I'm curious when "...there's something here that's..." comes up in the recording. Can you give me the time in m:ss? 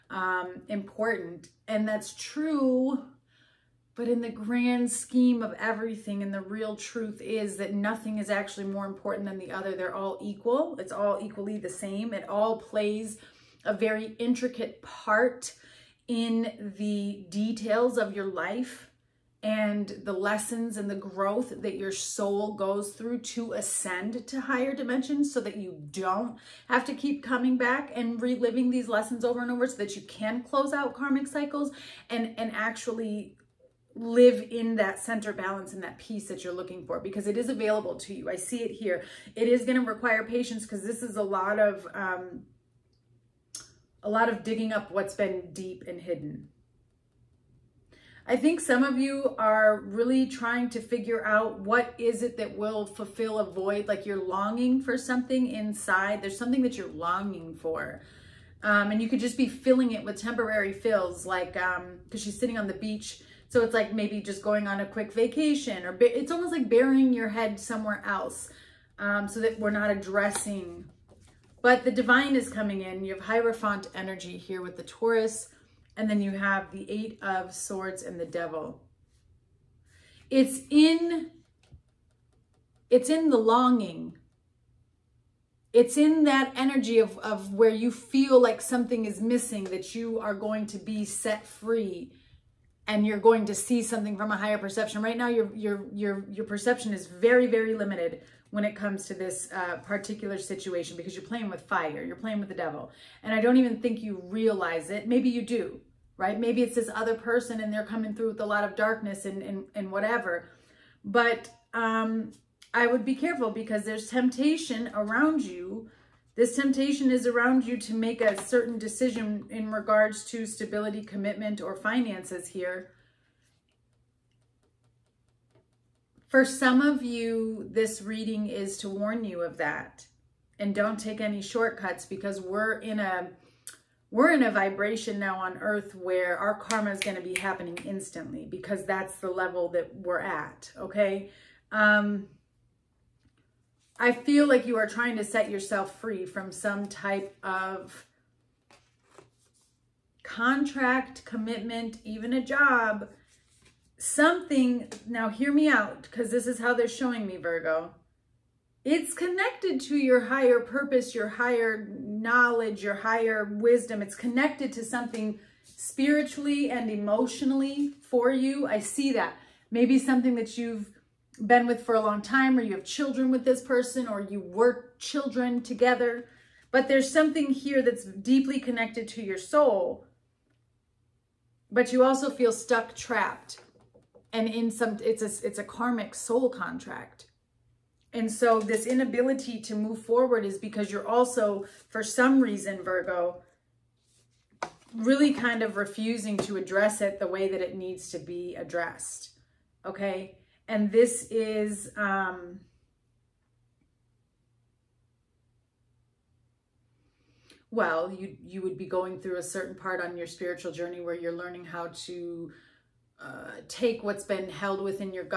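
2:56.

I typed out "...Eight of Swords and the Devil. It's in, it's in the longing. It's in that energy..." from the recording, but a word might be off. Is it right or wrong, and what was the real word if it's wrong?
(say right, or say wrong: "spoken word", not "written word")
right.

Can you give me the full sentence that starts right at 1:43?
And I don't even think you realize it.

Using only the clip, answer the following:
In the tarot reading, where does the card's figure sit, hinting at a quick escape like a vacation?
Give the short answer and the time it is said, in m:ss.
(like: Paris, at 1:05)
On the beach, at 1:02.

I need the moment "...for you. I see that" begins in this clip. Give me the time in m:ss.
2:48.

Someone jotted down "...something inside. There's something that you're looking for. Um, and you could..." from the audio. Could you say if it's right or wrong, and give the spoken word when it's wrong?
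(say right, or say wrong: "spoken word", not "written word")
wrong: "longing", not "looking".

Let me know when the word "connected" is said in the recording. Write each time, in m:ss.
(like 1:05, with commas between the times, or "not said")
2:39, 2:44, 2:58.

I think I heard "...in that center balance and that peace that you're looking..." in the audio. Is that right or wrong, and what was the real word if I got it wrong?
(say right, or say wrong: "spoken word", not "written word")
right.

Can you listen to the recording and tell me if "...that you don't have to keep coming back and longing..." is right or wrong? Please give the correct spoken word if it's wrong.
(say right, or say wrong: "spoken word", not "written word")
wrong: "reliving", not "longing".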